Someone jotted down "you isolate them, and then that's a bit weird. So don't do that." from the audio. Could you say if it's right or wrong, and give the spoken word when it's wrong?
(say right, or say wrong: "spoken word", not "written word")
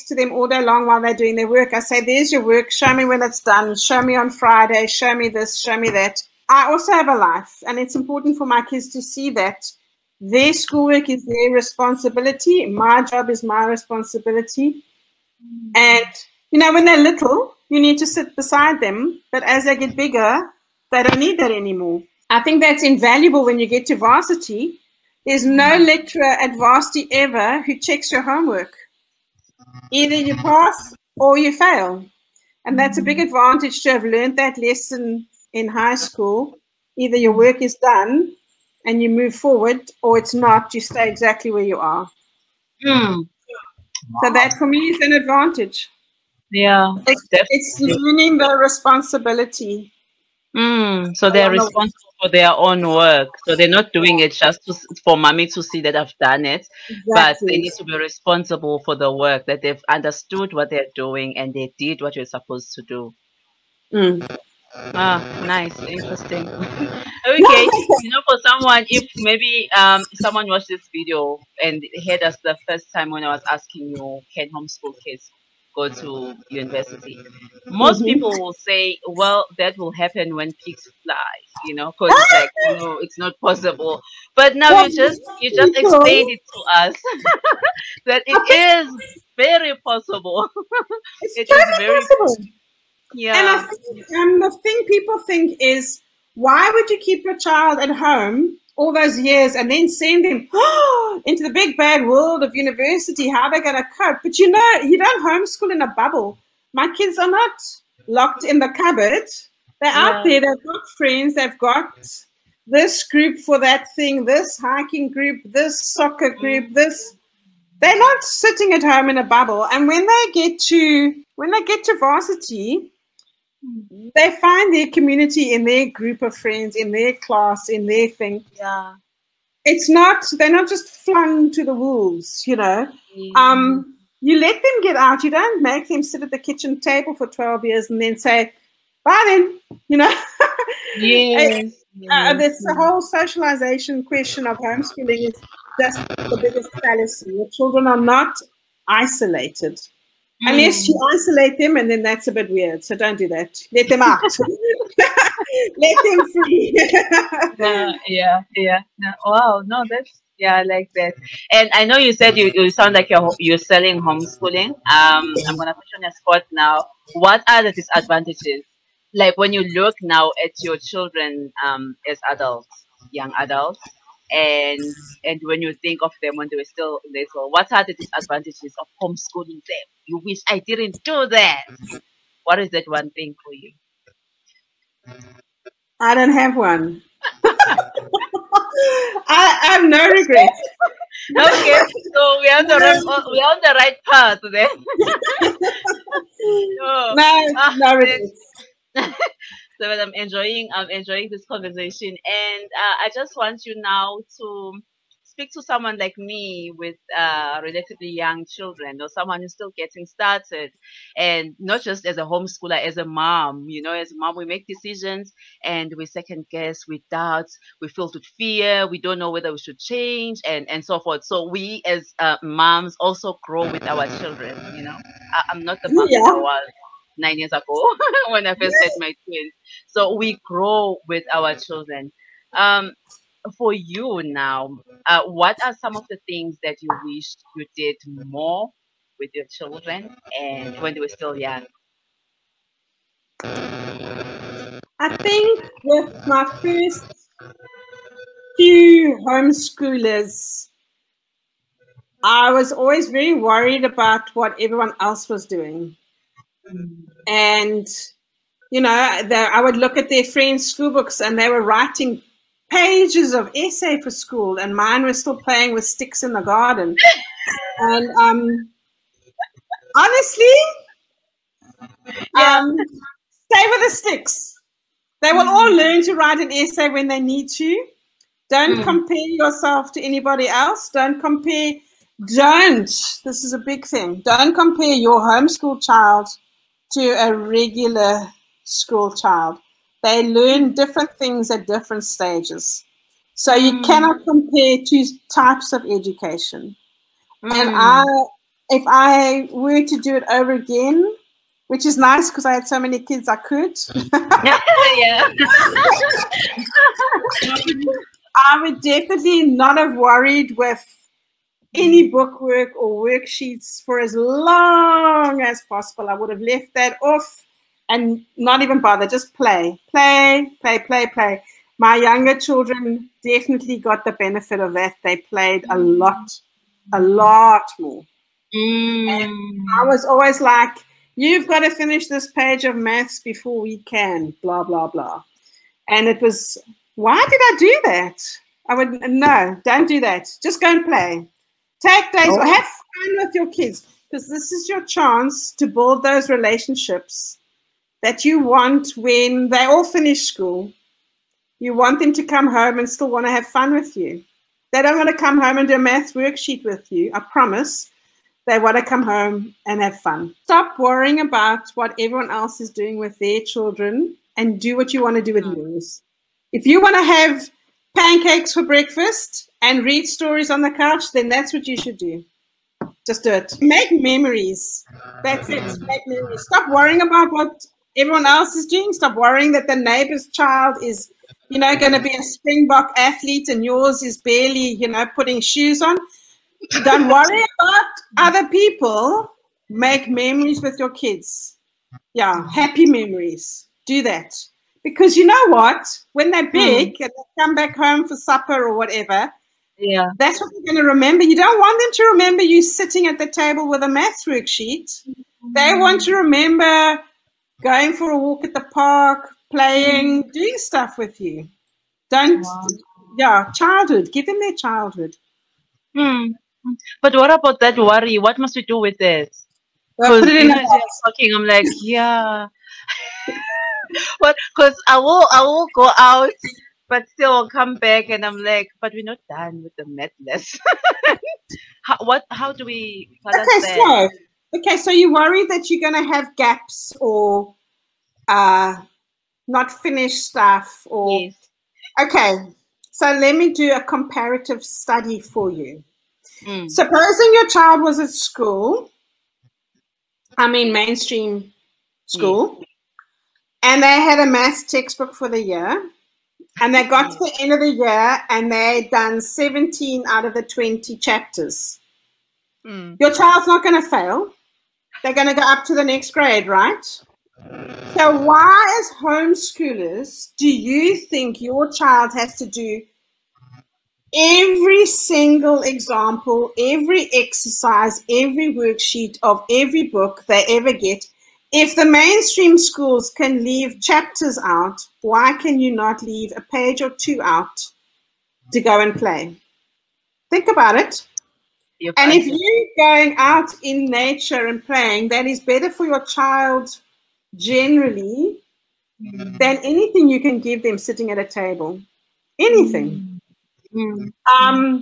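right.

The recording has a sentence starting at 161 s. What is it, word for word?
And I know you said you, you sound like you're you're selling homeschooling.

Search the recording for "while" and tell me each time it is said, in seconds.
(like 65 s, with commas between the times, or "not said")
0 s.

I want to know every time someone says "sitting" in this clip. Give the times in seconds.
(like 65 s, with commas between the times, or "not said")
118 s, 402 s, 500 s.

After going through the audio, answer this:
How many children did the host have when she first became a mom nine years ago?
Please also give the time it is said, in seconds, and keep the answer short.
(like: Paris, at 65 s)
twins, at 229 s.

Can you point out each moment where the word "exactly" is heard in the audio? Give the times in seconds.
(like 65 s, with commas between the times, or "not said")
41 s, 56 s.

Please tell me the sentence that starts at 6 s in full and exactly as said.
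I also have a life, and it's important for my kids to see that their schoolwork is their responsibility.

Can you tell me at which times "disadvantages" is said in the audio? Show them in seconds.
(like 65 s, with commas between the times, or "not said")
167 s, 177 s.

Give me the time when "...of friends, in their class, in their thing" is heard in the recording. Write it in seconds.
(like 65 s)
126 s.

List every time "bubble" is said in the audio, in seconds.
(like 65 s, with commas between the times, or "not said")
105 s, 119 s.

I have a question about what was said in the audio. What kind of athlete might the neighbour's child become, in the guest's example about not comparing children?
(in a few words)
Springbok.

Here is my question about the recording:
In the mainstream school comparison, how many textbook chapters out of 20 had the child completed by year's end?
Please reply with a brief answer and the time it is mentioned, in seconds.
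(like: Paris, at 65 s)
17, at 459 s.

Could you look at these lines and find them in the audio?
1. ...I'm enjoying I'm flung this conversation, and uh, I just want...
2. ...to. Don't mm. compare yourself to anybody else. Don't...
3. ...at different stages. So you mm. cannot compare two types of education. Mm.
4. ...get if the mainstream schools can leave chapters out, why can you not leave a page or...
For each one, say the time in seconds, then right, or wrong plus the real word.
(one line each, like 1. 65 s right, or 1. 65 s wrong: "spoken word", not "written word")
1. 199 s wrong: "enjoying", not "flung"
2. 277 s right
3. 291 s right
4. 480 s right.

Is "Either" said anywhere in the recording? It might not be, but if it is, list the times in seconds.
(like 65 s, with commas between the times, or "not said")
29 s, 36 s.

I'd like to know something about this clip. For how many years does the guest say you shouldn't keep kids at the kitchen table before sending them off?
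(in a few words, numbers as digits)
12.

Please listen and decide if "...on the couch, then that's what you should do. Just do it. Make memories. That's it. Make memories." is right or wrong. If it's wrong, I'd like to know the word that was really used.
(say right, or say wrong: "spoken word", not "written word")
right.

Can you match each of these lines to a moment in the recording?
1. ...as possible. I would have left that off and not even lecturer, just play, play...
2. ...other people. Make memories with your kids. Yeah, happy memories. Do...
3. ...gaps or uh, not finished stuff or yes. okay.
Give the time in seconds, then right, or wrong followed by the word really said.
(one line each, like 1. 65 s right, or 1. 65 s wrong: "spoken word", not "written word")
1. 315 s wrong: "bother", not "lecturer"
2. 388 s right
3. 436 s right.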